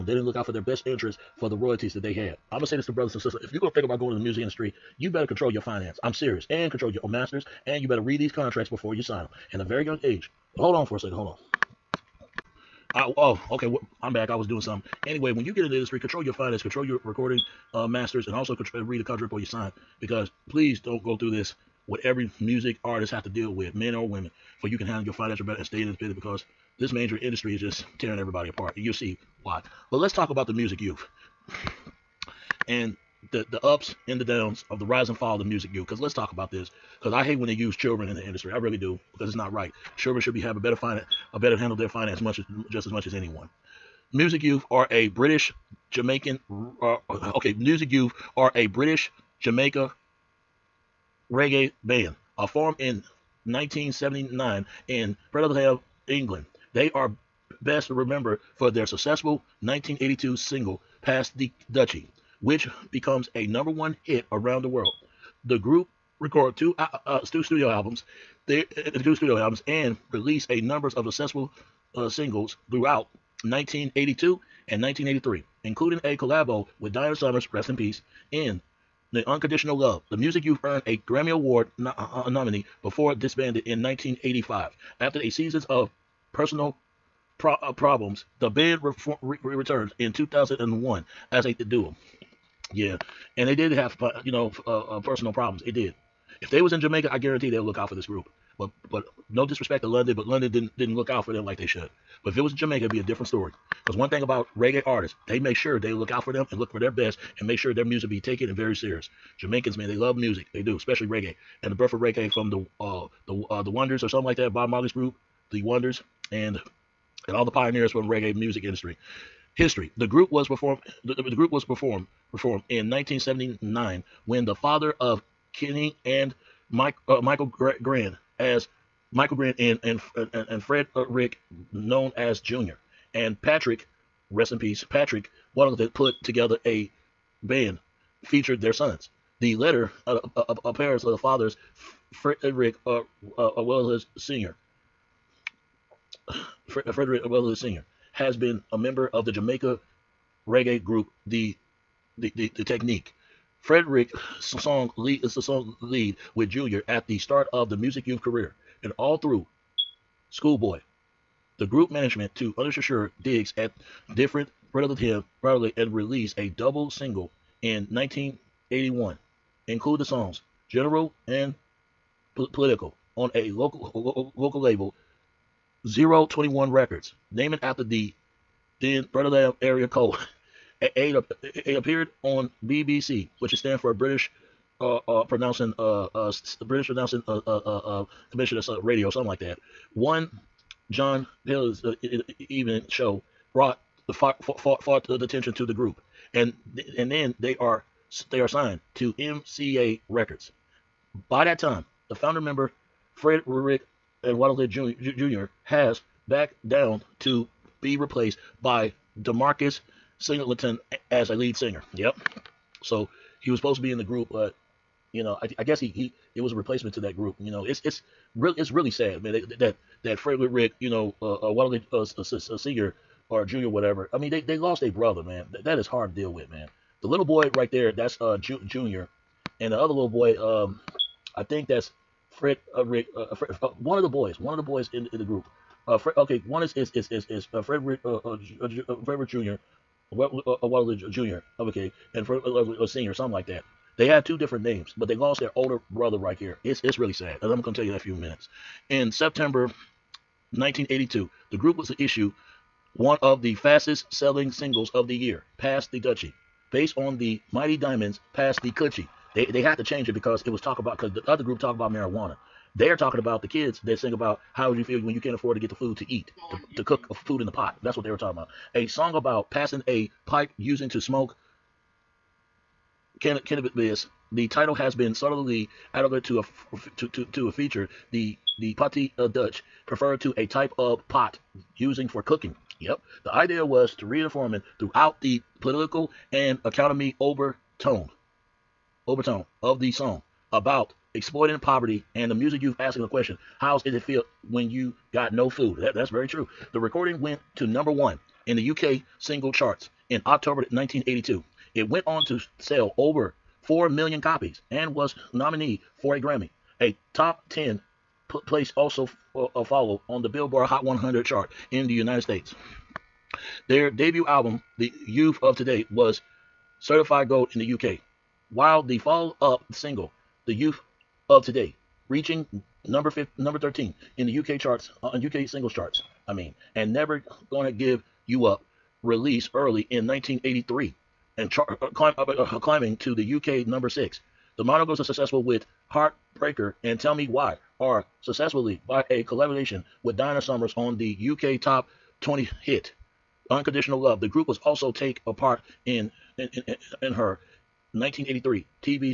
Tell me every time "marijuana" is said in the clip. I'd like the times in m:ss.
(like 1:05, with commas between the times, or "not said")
4:21.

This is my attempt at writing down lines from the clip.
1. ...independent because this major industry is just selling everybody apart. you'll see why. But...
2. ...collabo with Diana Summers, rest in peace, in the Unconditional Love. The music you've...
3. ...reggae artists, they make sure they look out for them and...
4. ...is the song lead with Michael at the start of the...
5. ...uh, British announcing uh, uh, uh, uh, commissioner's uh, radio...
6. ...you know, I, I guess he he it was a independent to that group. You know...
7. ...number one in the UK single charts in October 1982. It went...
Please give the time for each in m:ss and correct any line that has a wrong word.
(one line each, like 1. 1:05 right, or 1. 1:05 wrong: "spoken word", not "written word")
1. 0:25 wrong: "tearing", not "selling"
2. 1:16 right
3. 1:44 right
4. 2:35 wrong: "Junior", not "Michael"
5. 3:06 right
6. 3:35 wrong: "replacement", not "independent"
7. 4:57 right.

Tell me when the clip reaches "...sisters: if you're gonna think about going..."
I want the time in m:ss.
0:03.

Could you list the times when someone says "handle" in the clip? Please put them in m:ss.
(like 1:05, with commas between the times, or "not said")
0:24, 0:41.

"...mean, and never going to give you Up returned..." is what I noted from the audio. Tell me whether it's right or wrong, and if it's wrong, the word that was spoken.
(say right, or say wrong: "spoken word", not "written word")
wrong: "released", not "returned".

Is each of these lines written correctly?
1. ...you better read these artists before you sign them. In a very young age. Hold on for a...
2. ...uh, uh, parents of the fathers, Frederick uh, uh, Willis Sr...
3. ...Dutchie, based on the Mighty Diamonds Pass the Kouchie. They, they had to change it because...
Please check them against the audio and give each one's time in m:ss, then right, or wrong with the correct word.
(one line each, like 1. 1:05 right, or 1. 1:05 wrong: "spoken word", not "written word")
1. 0:07 wrong: "contracts", not "artists"
2. 2:20 right
3. 4:15 right.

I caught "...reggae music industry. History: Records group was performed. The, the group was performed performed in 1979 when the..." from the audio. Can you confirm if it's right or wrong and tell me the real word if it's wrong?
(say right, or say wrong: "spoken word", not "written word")
wrong: "The", not "Records".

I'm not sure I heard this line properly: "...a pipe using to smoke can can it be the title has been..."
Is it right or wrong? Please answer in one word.
right.